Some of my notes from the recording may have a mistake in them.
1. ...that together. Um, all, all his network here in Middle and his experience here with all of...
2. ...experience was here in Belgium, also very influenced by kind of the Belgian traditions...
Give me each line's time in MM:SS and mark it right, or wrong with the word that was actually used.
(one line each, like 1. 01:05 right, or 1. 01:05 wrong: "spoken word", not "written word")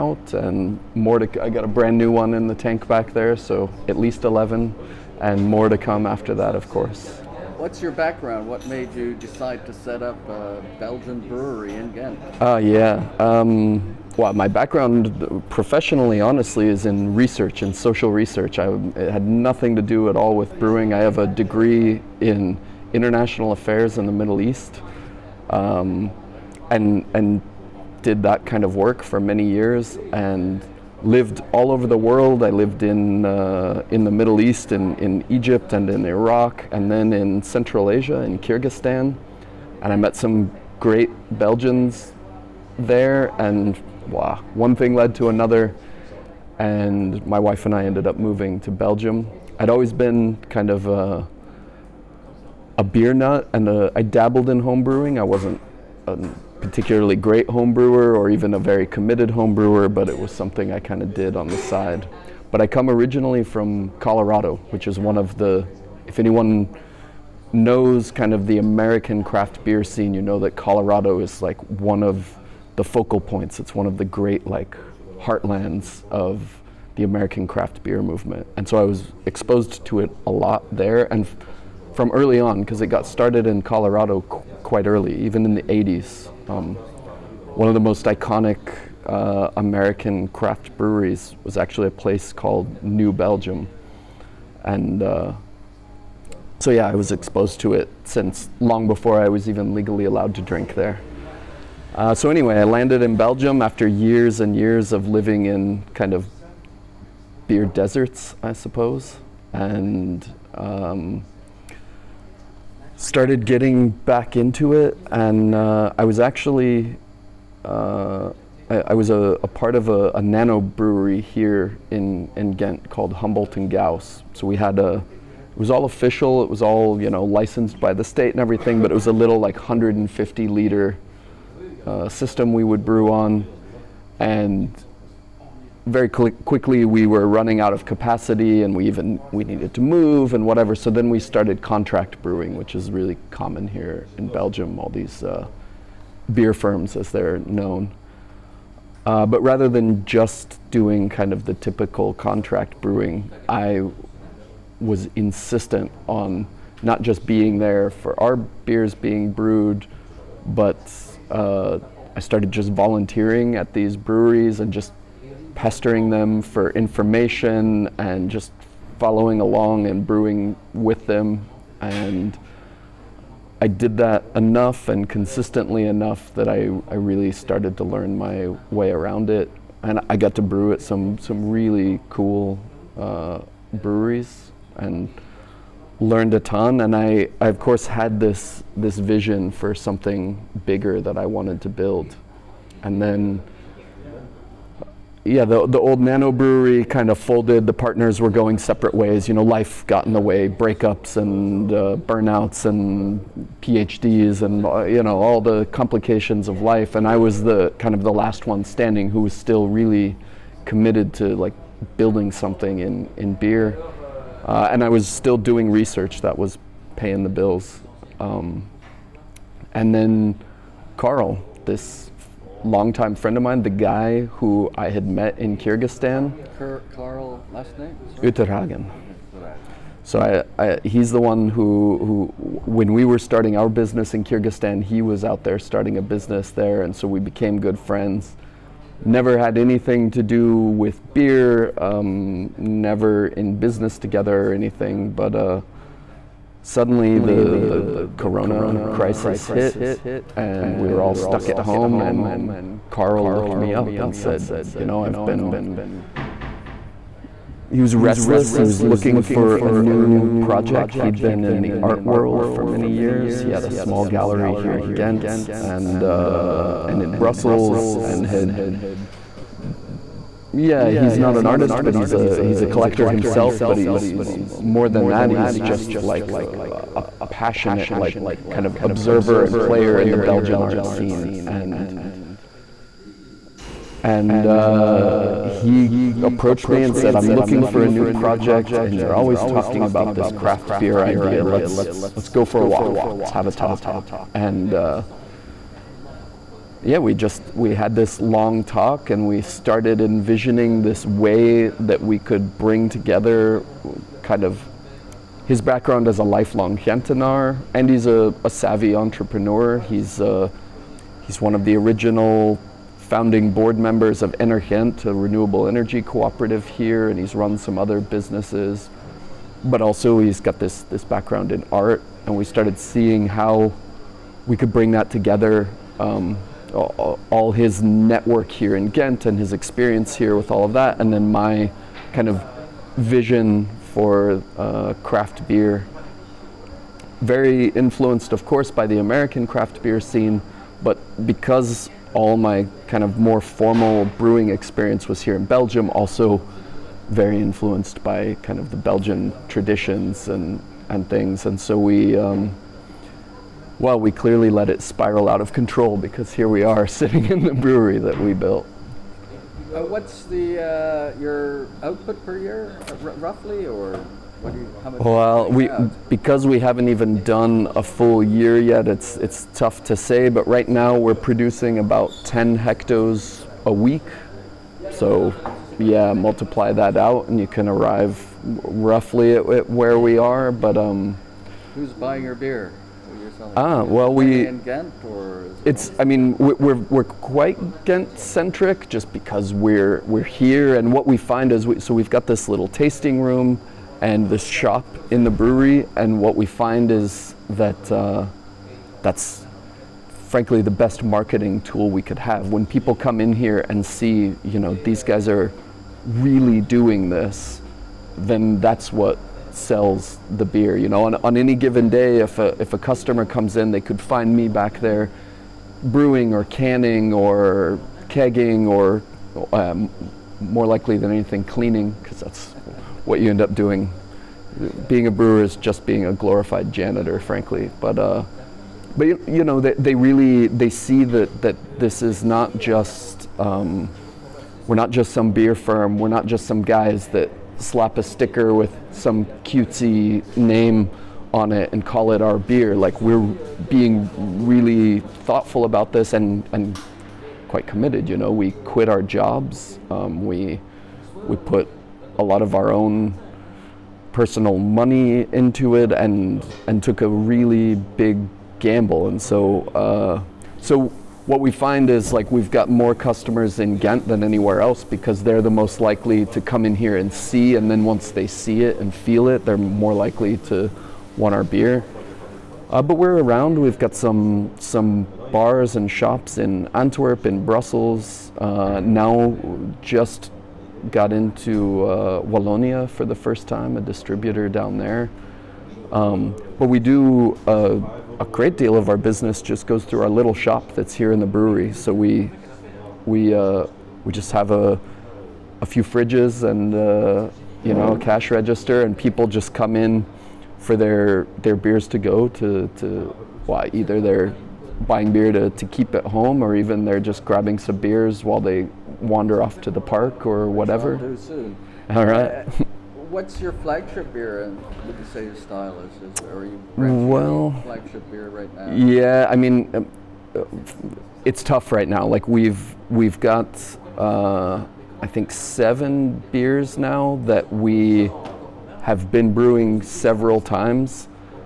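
1. 05:24 wrong: "Ghent", not "Middle"
2. 05:44 right.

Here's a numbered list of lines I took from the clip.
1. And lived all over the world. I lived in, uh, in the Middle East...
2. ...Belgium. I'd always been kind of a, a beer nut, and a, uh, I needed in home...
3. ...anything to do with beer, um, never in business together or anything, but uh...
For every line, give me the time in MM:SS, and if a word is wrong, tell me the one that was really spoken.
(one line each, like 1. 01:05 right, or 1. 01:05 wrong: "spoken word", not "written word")
1. 00:30 right
2. 00:48 wrong: "dabbled", not "needed"
3. 03:59 right.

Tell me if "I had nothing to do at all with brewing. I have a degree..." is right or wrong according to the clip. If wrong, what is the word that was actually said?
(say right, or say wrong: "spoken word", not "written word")
right.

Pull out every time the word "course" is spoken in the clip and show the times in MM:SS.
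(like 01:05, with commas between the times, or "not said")
00:06, 03:07, 05:38.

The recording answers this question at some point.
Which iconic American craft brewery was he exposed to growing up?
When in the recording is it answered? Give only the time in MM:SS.
01:32.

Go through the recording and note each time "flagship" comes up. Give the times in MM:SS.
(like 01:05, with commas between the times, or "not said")
08:33, 08:37.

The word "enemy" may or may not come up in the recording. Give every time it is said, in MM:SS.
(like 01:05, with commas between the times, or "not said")
not said.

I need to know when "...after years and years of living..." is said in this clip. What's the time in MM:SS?
01:43.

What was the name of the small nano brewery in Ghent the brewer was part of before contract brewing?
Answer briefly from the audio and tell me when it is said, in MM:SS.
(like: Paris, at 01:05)
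Humboldt and Gauss, at 02:03.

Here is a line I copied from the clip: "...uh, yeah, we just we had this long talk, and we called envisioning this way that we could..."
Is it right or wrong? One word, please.
wrong.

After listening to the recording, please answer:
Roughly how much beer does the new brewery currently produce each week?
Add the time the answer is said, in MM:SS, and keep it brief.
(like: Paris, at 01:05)
10 hectoliters, at 06:12.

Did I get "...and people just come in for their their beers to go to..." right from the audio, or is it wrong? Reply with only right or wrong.
right.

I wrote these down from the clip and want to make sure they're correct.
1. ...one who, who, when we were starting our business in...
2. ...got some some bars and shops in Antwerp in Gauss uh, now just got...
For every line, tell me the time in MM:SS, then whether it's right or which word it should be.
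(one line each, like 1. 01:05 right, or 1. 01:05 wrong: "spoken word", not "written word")
1. 03:51 right
2. 07:53 wrong: "Brussels", not "Gauss".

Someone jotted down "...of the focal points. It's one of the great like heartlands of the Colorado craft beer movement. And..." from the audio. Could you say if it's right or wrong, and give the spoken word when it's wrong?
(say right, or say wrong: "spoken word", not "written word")
wrong: "American", not "Colorado".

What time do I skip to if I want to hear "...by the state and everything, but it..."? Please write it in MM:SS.
02:07.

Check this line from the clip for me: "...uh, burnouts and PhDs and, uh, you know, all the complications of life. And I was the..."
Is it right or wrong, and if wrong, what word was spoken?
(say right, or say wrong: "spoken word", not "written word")
right.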